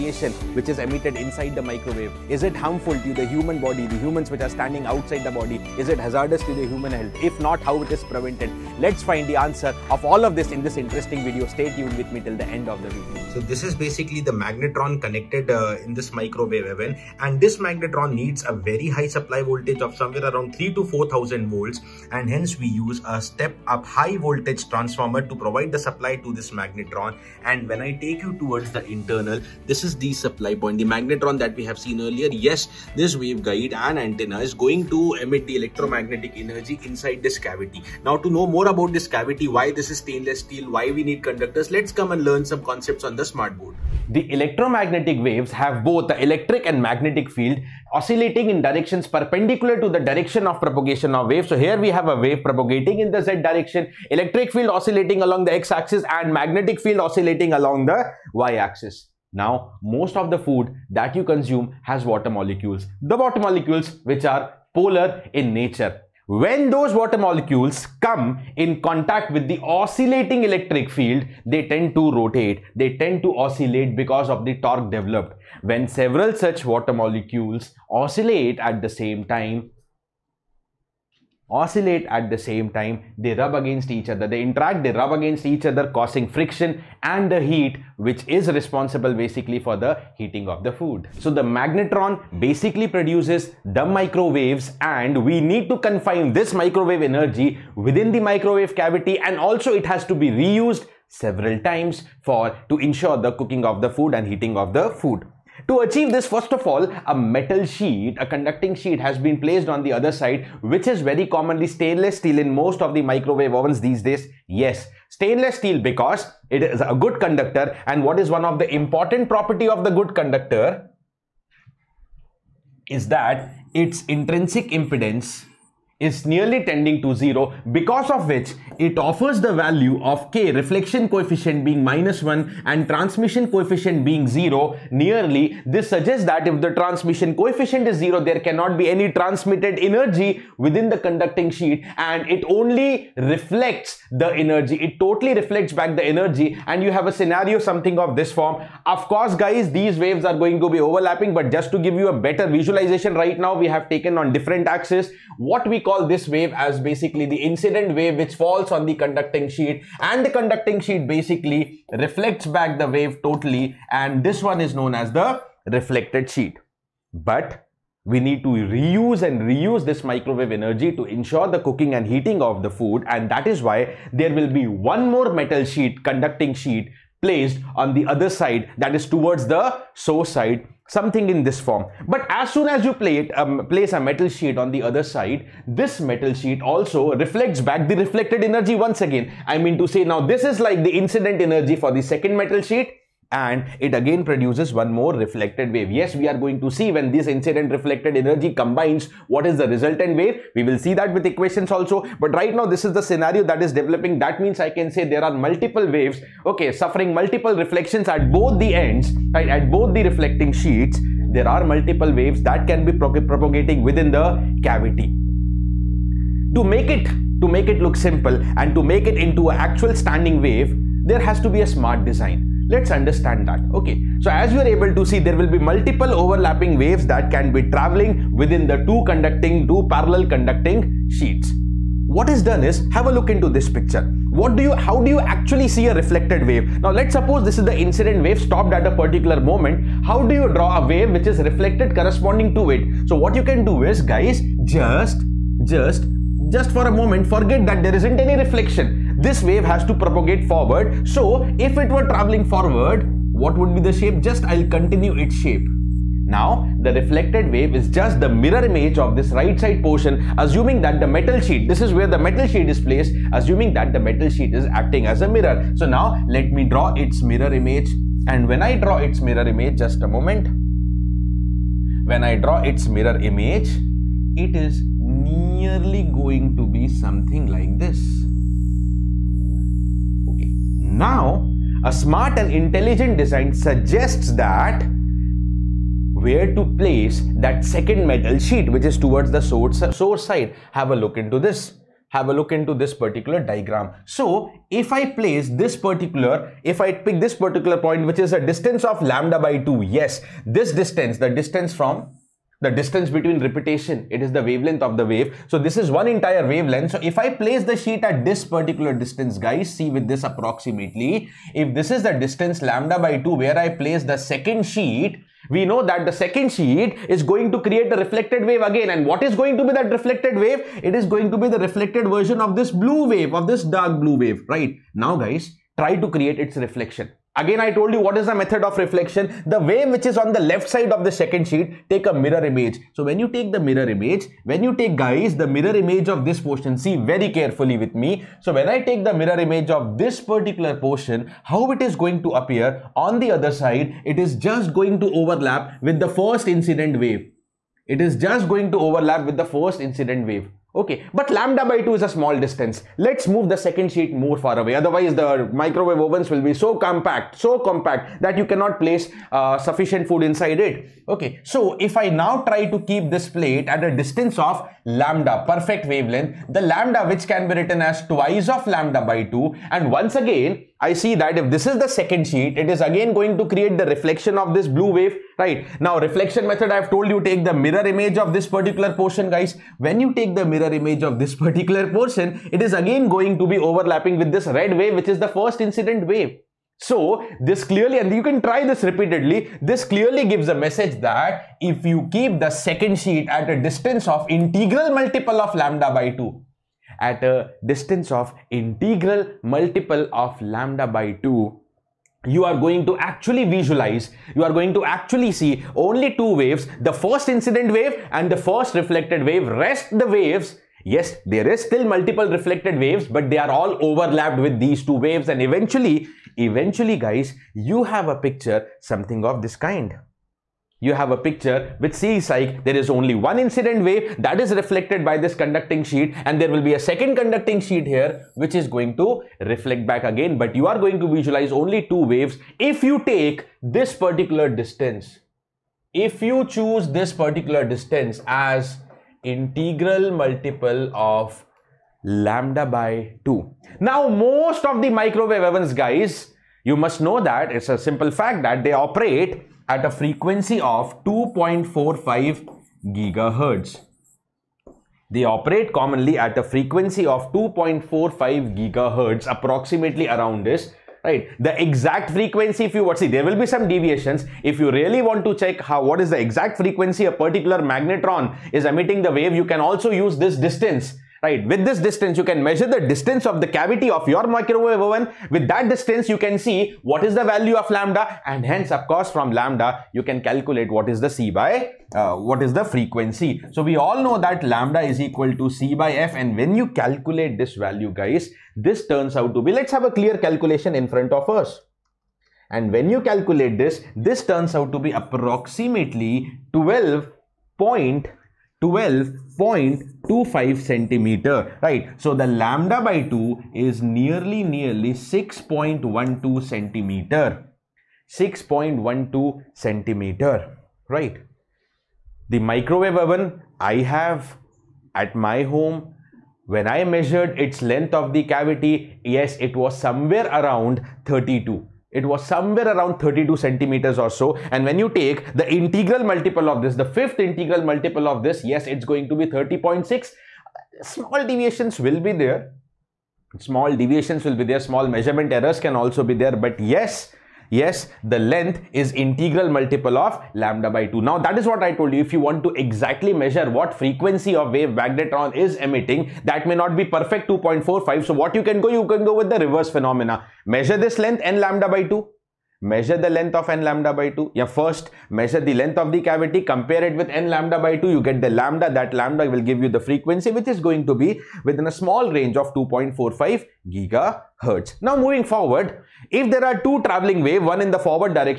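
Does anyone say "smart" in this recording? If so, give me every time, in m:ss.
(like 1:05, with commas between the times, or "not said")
0:43, 3:41, 4:41.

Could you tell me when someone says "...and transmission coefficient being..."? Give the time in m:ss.
2:12.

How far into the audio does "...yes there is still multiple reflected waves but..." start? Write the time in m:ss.
6:50.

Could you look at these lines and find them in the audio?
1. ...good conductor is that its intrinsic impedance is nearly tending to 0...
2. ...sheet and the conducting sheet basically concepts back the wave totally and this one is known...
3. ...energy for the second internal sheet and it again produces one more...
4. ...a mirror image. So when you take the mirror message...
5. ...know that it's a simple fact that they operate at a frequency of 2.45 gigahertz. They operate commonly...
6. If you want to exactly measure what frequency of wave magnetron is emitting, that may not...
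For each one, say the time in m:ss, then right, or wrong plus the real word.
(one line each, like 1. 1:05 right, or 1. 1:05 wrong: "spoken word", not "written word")
1. 1:59 right
2. 2:39 wrong: "reflects", not "concepts"
3. 3:11 wrong: "metal", not "internal"
4. 5:32 wrong: "image", not "message"
5. 7:27 right
6. 9:02 right.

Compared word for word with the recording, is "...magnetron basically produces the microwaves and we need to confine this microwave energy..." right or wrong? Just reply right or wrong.
right.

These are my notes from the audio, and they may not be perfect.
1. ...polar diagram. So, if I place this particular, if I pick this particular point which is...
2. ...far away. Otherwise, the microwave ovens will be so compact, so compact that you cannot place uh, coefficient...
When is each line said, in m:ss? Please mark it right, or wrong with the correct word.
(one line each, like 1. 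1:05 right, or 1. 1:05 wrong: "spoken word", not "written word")
1. 4:52 wrong: "particular", not "polar"
2. 5:54 wrong: "sufficient", not "coefficient".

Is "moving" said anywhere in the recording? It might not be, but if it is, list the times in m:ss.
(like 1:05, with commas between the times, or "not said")
9:25.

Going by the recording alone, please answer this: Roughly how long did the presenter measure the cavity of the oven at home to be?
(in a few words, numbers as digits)
32 cm.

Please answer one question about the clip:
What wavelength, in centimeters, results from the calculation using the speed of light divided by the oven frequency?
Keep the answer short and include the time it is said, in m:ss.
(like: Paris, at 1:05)
12.25 cm, at 8:18.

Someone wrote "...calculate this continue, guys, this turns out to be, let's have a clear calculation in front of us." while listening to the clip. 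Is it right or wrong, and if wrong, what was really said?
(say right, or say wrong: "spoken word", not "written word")
wrong: "value", not "continue".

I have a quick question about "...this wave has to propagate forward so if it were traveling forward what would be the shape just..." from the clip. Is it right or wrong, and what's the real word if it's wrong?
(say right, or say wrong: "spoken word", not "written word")
right.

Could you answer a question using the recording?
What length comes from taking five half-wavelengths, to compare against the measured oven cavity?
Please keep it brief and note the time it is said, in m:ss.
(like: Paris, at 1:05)
30.6, at 8:49.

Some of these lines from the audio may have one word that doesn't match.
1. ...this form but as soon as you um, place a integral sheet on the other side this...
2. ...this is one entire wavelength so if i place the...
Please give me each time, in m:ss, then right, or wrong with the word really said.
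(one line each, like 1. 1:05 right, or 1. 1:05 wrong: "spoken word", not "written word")
1. 3:01 wrong: "metal", not "integral"
2. 5:05 right.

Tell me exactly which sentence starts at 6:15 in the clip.
Now, reflection method, I've told you take the mirror image of this particular portion, guys.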